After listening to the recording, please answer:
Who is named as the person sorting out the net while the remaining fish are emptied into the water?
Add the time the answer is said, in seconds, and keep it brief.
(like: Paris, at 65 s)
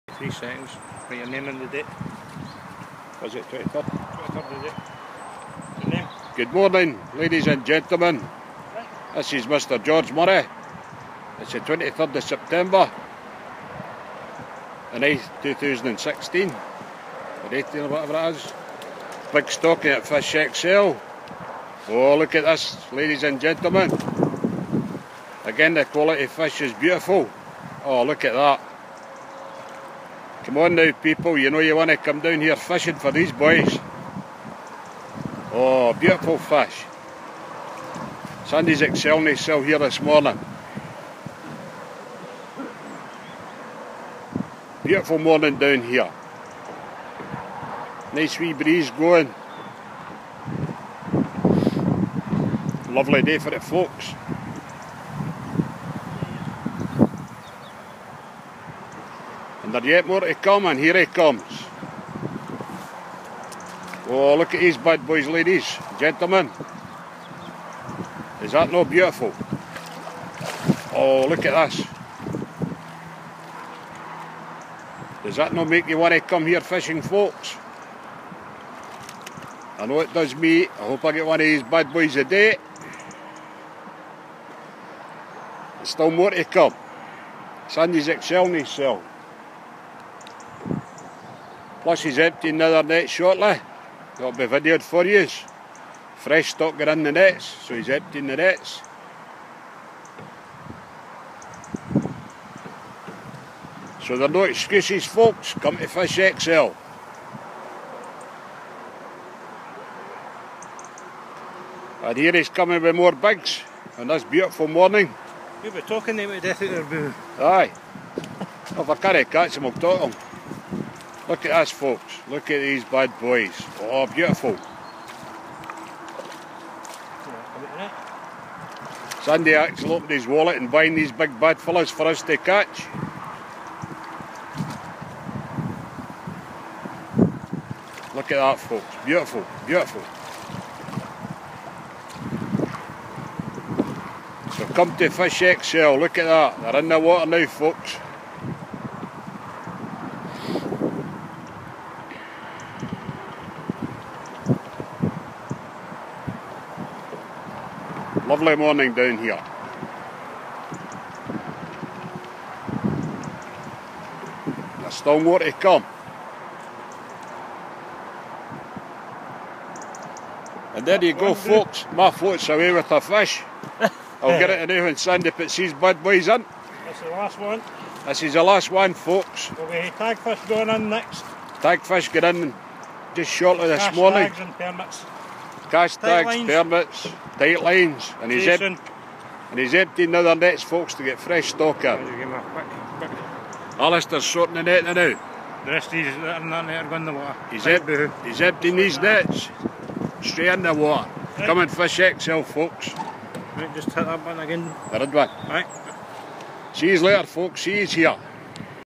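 Alistair, at 193 s.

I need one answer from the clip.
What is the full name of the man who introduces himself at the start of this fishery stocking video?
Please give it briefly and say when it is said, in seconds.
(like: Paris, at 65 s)
George Murray, at 9 s.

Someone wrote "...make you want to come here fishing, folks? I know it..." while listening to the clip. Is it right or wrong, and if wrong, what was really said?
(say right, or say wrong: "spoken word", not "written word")
right.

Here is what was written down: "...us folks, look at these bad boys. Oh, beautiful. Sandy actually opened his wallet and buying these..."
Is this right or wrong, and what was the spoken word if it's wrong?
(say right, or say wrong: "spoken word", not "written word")
right.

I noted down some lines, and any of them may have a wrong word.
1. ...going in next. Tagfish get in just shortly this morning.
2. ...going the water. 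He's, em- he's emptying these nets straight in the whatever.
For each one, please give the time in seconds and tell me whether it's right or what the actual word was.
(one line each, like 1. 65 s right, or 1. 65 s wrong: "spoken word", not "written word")
1. 180 s right
2. 196 s wrong: "water", not "whatever".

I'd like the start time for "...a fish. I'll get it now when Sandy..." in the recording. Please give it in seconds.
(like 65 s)
172 s.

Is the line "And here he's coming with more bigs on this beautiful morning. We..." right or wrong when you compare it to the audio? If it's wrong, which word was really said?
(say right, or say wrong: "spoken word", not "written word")
right.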